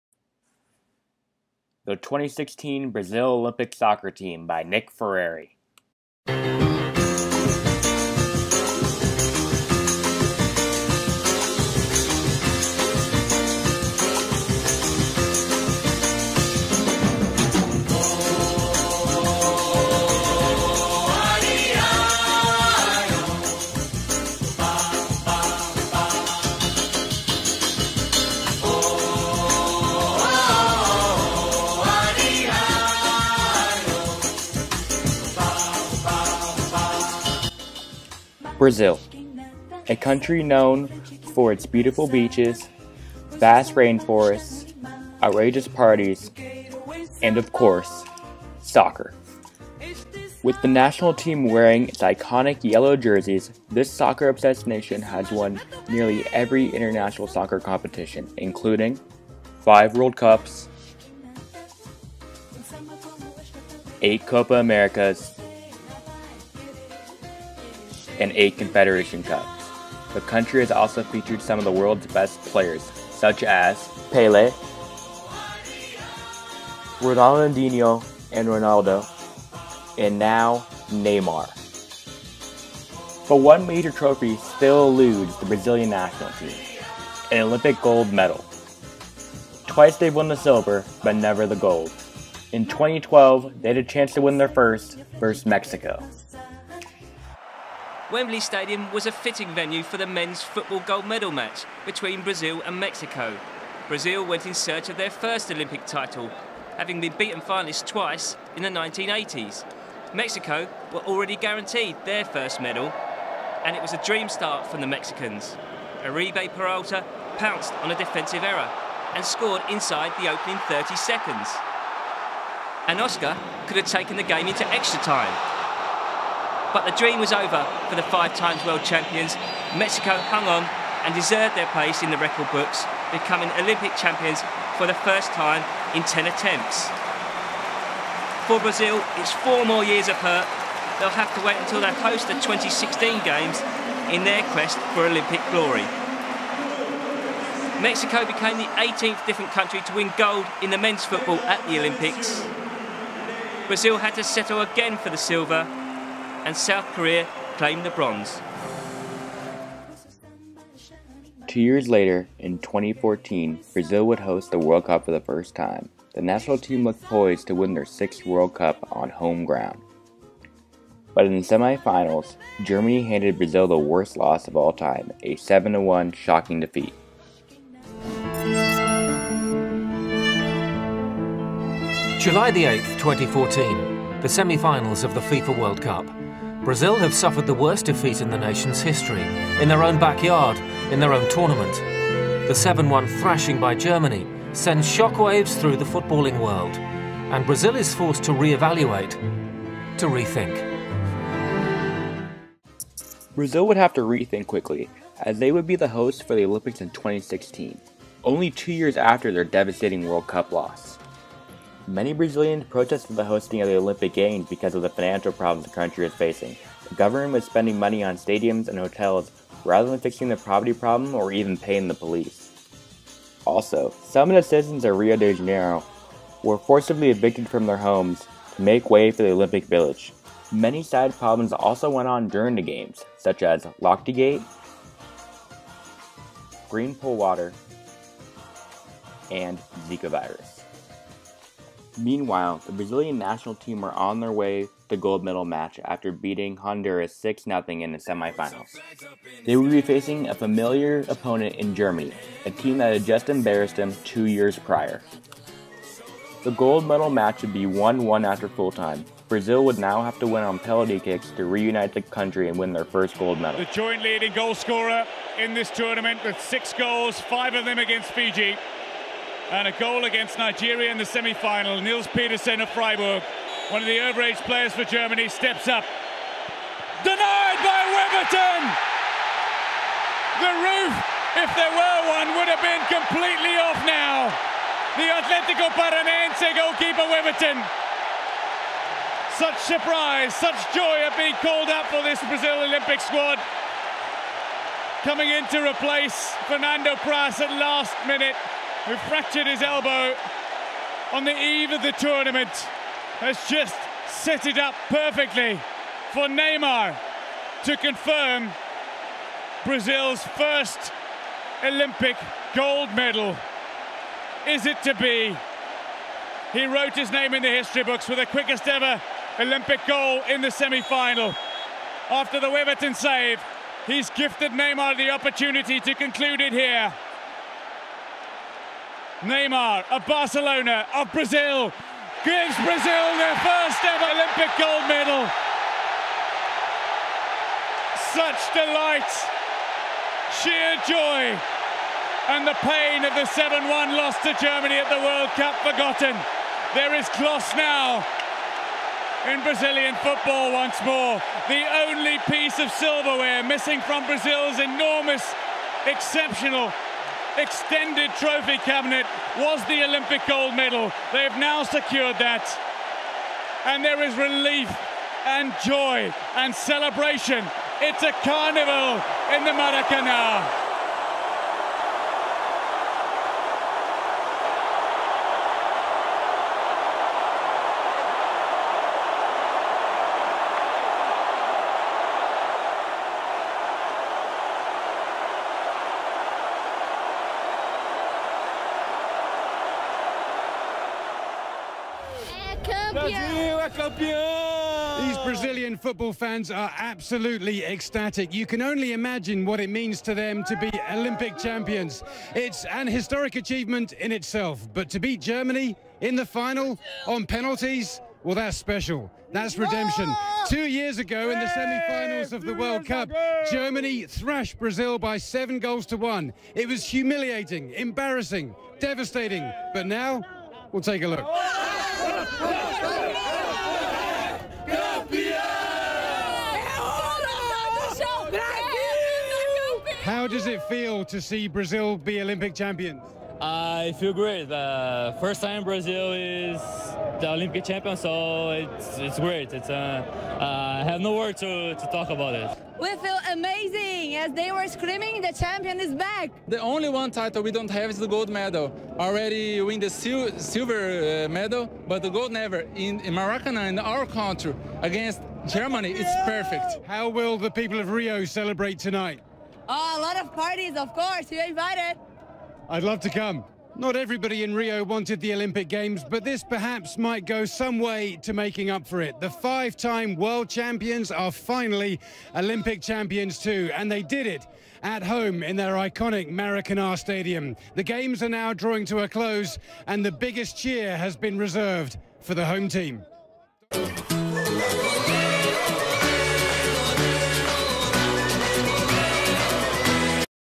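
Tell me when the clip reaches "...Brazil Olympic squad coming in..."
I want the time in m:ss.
4:52.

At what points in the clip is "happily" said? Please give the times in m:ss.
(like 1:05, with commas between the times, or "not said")
not said.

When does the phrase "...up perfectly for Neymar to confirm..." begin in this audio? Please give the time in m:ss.
5:04.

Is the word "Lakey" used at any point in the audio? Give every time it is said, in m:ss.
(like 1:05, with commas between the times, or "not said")
not said.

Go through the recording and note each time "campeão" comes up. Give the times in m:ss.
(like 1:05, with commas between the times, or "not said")
6:33.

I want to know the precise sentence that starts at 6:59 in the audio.
But now, we'll take a look.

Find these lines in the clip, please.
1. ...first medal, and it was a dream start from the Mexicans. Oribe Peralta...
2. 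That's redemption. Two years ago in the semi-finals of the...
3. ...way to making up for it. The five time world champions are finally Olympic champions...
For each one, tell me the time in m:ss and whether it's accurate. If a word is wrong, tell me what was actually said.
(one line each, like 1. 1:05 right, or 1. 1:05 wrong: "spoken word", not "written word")
1. 1:52 right
2. 6:49 right
3. 7:47 right.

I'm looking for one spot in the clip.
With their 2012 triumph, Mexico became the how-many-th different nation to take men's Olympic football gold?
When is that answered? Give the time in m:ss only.
2:28.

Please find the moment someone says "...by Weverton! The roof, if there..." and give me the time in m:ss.
4:37.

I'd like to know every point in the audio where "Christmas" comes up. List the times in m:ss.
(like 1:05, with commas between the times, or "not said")
not said.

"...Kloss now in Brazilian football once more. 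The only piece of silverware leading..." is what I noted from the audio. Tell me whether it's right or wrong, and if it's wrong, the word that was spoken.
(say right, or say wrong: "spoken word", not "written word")
wrong: "missing", not "leading".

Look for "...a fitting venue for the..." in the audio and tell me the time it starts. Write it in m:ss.
1:39.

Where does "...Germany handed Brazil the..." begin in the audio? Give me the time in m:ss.
2:52.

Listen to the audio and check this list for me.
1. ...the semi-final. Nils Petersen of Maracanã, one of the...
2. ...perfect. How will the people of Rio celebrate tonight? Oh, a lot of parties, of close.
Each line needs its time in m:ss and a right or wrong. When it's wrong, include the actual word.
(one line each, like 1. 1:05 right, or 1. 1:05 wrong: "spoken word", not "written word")
1. 4:30 wrong: "Freiburg", not "Maracanã"
2. 7:36 wrong: "course", not "close".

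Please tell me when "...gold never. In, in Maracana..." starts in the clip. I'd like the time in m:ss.
7:32.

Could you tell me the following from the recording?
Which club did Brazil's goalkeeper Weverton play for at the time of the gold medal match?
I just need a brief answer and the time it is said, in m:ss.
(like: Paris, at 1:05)
Atletico Paranaense, at 4:45.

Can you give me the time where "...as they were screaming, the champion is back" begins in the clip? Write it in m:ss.
7:24.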